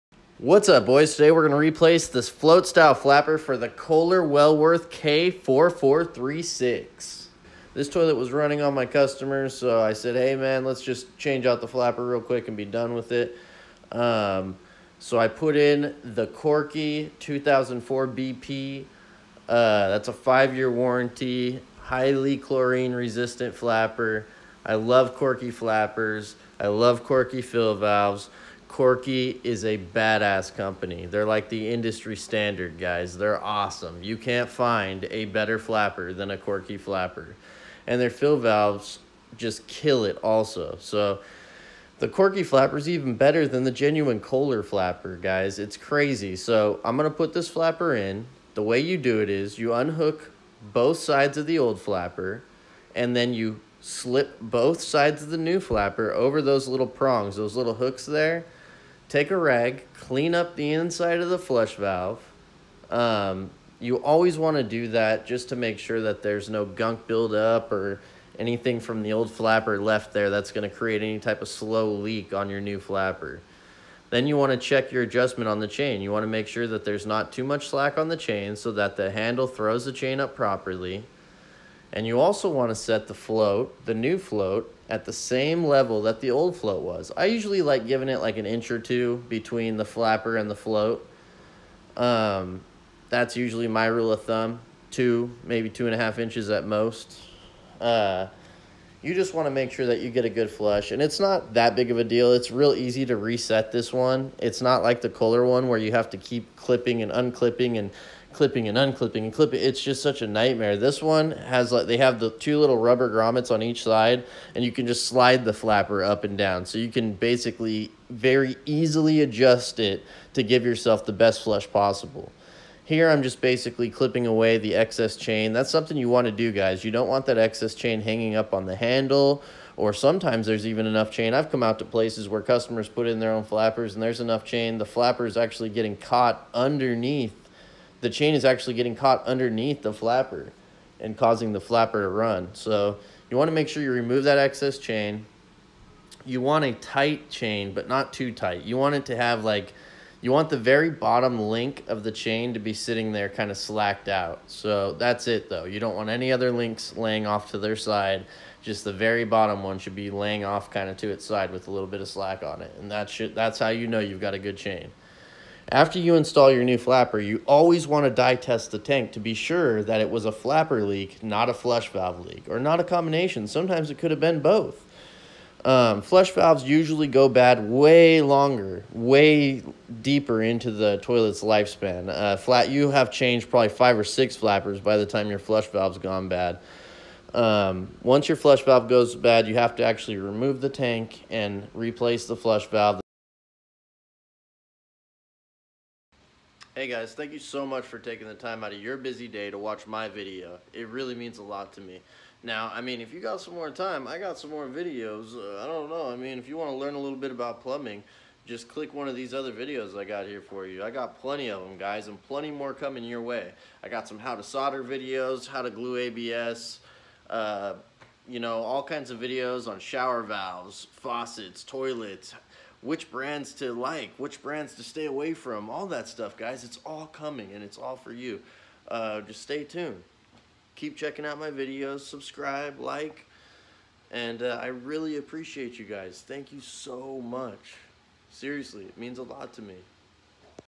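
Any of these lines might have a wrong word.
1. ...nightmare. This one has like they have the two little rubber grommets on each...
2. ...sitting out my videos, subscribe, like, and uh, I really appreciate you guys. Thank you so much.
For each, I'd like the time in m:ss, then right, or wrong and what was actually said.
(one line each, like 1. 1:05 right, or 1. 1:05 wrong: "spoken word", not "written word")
1. 1:50 right
2. 3:50 wrong: "checking", not "sitting".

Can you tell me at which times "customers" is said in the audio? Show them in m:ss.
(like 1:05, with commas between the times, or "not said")
0:08, 2:12.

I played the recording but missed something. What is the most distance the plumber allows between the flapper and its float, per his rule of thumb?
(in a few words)
2.5 inches.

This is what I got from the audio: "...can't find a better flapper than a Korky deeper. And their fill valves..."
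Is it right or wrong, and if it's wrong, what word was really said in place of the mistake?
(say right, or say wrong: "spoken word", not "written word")
wrong: "flapper", not "deeper".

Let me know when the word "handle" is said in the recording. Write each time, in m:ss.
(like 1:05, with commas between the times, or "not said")
1:19, 2:08.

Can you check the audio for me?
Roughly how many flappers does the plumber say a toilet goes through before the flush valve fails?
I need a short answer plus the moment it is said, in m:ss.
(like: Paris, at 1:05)
5 or 6, at 3:03.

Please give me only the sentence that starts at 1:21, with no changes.
And you also want to set the float, the new float, at the same level that the old float was.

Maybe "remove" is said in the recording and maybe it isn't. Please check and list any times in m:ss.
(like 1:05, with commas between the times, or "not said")
2:23, 3:10.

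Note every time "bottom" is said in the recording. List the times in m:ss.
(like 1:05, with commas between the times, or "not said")
2:30, 2:39.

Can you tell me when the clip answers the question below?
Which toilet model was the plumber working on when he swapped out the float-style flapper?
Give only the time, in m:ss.
0:03.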